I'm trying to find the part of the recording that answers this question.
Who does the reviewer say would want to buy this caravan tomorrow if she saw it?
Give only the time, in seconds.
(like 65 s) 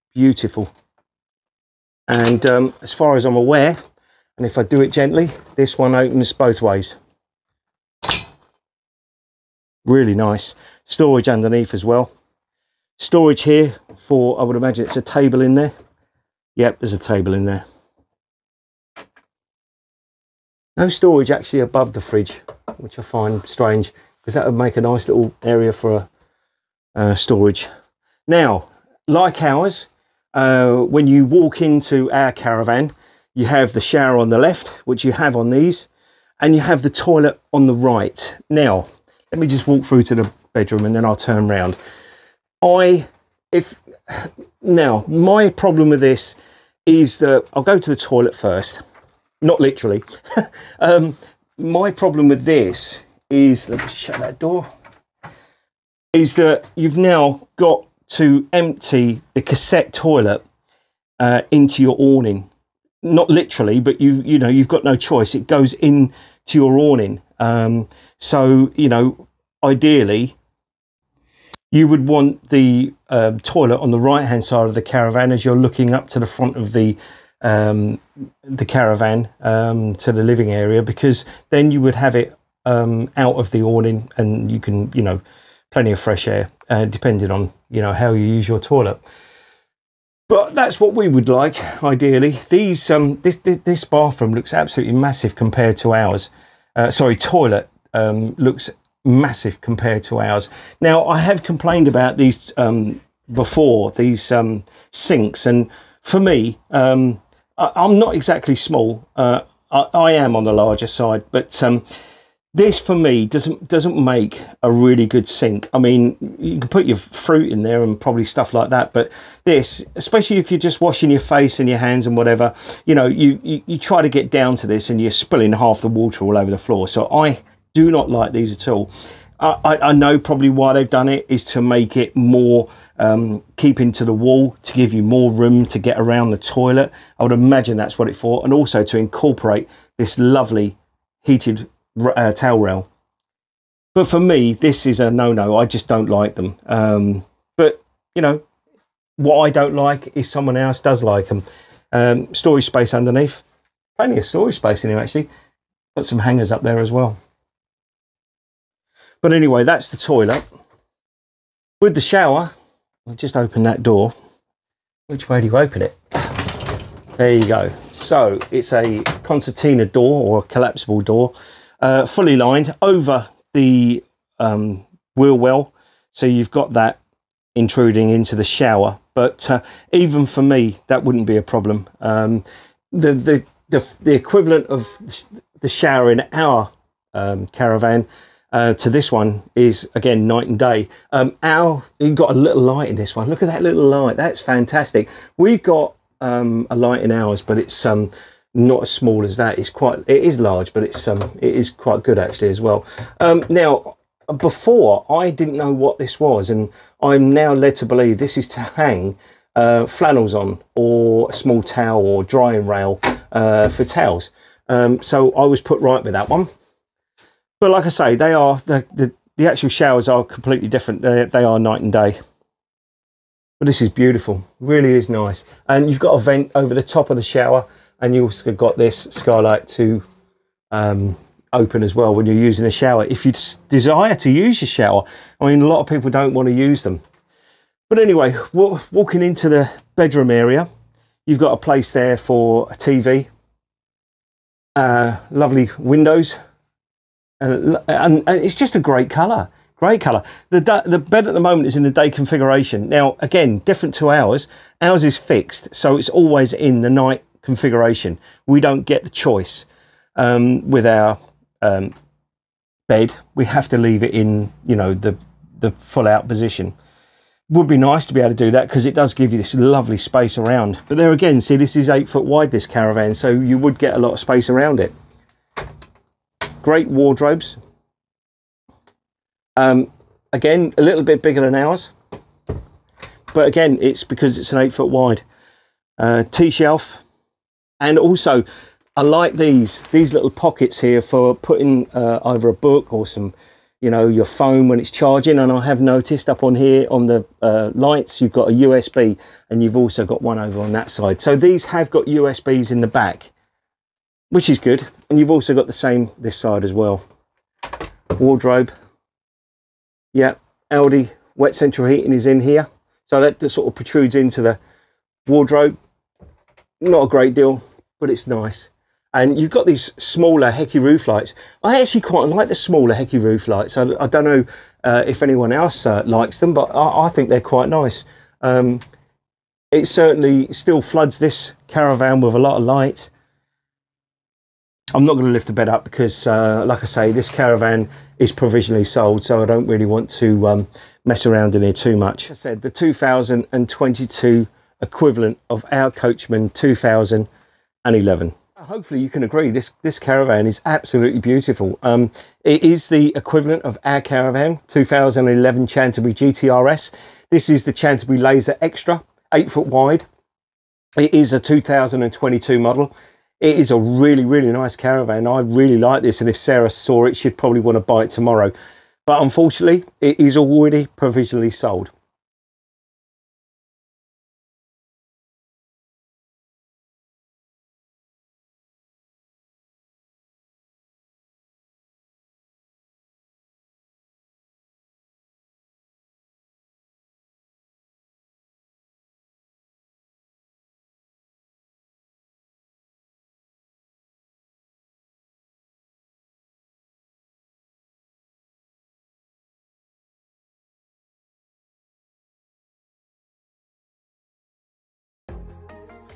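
366 s.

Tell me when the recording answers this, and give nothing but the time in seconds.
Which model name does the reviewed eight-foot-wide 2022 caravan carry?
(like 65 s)
357 s.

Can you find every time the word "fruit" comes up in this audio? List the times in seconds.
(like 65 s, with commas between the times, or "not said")
116 s.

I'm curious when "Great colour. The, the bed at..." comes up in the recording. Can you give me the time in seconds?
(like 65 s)
249 s.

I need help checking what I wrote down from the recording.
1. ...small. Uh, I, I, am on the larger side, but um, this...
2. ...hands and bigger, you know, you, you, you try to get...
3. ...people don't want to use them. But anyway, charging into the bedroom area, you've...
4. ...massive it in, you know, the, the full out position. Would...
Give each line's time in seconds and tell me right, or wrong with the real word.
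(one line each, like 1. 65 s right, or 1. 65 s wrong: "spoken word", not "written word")
1. 108 s right
2. 121 s wrong: "whatever", not "bigger"
3. 235 s wrong: "walking", not "charging"
4. 263 s wrong: "leave", not "massive".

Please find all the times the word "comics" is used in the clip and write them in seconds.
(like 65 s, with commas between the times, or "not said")
not said.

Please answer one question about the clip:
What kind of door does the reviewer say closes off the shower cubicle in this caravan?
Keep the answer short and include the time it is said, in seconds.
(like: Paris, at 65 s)
Concertina door, at 169 s.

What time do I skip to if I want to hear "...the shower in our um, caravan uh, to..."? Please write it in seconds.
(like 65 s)
185 s.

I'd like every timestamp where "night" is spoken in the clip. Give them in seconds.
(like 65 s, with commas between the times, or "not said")
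190 s, 221 s, 256 s.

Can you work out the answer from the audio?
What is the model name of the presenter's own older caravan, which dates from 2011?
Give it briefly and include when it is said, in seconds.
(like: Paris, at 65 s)
Chanterbury GTRS, at 355 s.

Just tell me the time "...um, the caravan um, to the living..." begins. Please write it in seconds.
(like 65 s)
77 s.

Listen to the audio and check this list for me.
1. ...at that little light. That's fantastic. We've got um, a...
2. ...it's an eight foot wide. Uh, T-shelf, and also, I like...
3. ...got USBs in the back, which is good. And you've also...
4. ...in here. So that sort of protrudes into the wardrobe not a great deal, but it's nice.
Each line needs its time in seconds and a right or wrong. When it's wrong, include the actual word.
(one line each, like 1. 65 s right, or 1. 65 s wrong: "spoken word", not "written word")
1. 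193 s right
2. 284 s right
3. 301 s right
4. 312 s right.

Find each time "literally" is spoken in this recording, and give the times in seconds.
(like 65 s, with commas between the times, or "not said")
49 s, 63 s.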